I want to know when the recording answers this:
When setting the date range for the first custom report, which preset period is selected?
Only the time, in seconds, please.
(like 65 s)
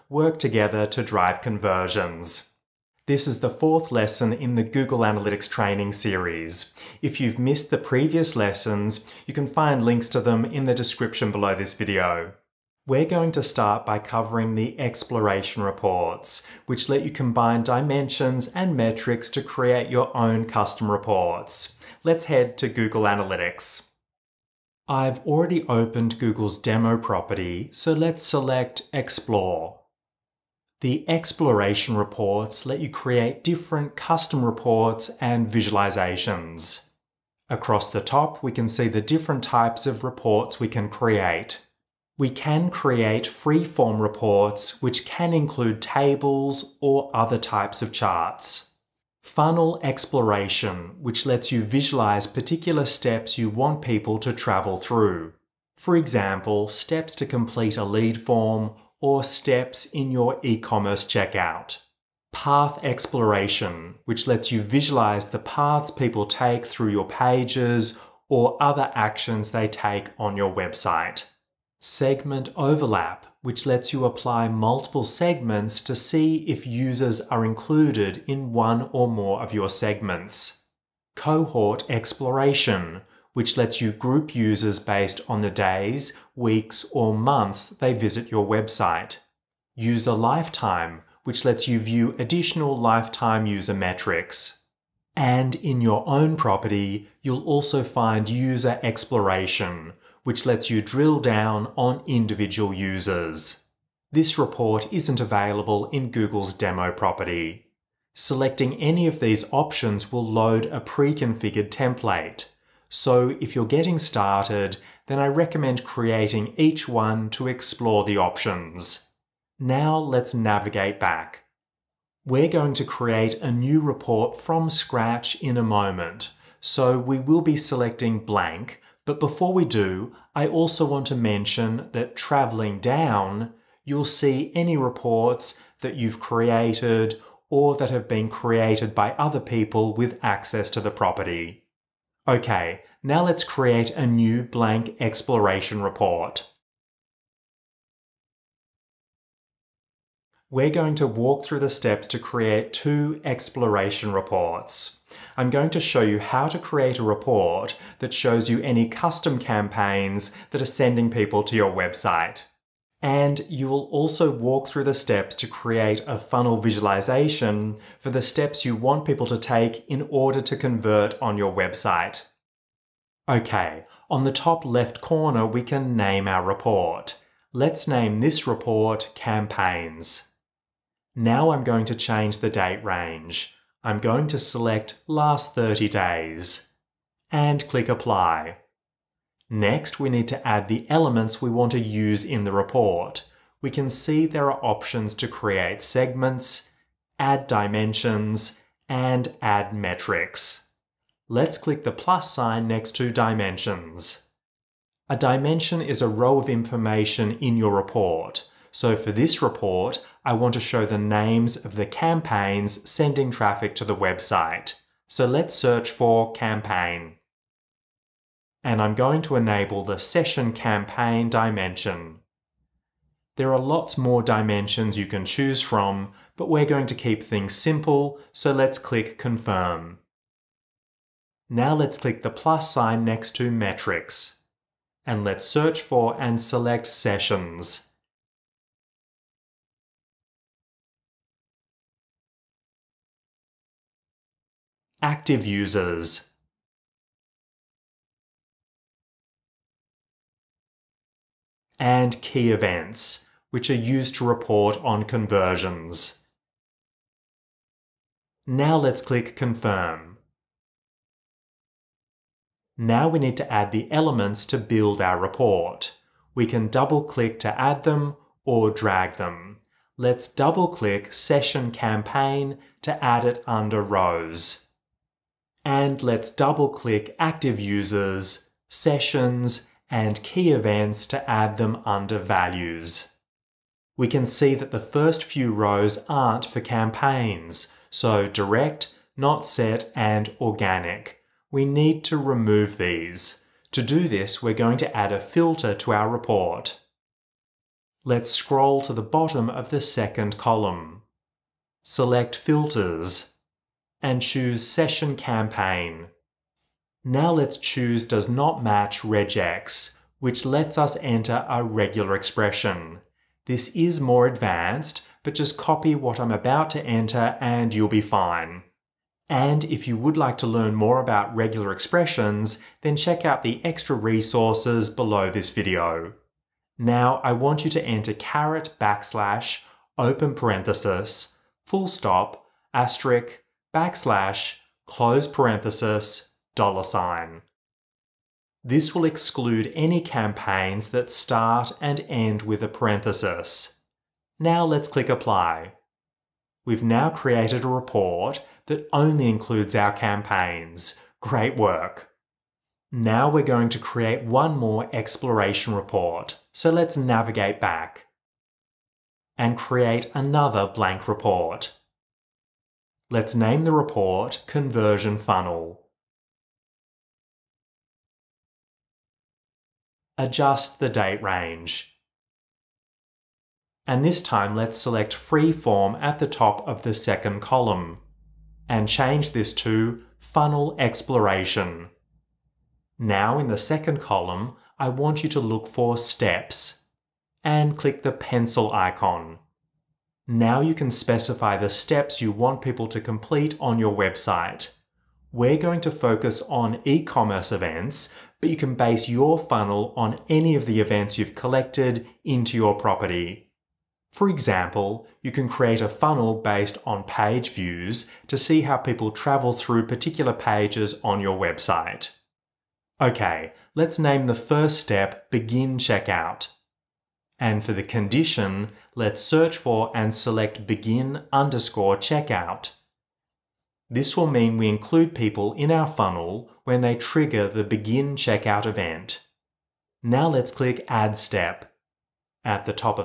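185 s.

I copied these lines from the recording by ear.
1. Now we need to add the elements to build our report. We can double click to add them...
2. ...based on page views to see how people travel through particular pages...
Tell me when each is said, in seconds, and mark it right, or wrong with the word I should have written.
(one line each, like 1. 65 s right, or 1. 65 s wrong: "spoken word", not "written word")
1. 262 s right
2. 406 s right.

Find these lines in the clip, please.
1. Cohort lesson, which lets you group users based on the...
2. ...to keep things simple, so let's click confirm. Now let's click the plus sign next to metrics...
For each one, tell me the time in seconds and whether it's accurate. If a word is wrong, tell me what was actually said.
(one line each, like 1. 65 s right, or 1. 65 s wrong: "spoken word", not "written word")
1. 81 s wrong: "exploration", not "lesson"
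2. 226 s right.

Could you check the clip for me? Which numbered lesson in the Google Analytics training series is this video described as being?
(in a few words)
fourth.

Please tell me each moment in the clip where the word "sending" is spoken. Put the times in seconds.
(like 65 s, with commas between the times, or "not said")
160 s, 212 s.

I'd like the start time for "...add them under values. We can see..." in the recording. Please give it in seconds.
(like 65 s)
281 s.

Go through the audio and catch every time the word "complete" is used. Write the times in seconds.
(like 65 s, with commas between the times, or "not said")
57 s, 392 s.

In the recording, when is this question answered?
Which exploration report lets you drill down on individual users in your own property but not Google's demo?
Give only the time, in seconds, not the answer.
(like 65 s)
98 s.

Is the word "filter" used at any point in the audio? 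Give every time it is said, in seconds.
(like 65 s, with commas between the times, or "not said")
295 s, 302 s.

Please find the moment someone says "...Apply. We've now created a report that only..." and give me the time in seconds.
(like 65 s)
345 s.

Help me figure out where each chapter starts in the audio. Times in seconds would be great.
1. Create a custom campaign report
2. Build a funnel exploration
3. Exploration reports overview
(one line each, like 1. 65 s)
1. 141 s
2. 352 s
3. 23 s.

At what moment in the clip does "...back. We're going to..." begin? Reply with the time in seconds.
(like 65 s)
120 s.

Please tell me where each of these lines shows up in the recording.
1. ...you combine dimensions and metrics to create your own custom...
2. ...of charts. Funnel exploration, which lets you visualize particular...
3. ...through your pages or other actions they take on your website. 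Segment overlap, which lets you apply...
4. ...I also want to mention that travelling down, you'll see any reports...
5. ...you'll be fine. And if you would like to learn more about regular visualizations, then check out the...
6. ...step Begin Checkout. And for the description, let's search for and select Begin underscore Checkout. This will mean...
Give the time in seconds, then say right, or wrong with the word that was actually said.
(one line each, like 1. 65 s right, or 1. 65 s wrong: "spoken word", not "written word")
1. 17 s right
2. 47 s right
3. 66 s right
4. 130 s right
5. 317 s wrong: "expressions", not "visualizations"
6. 414 s wrong: "condition", not "description".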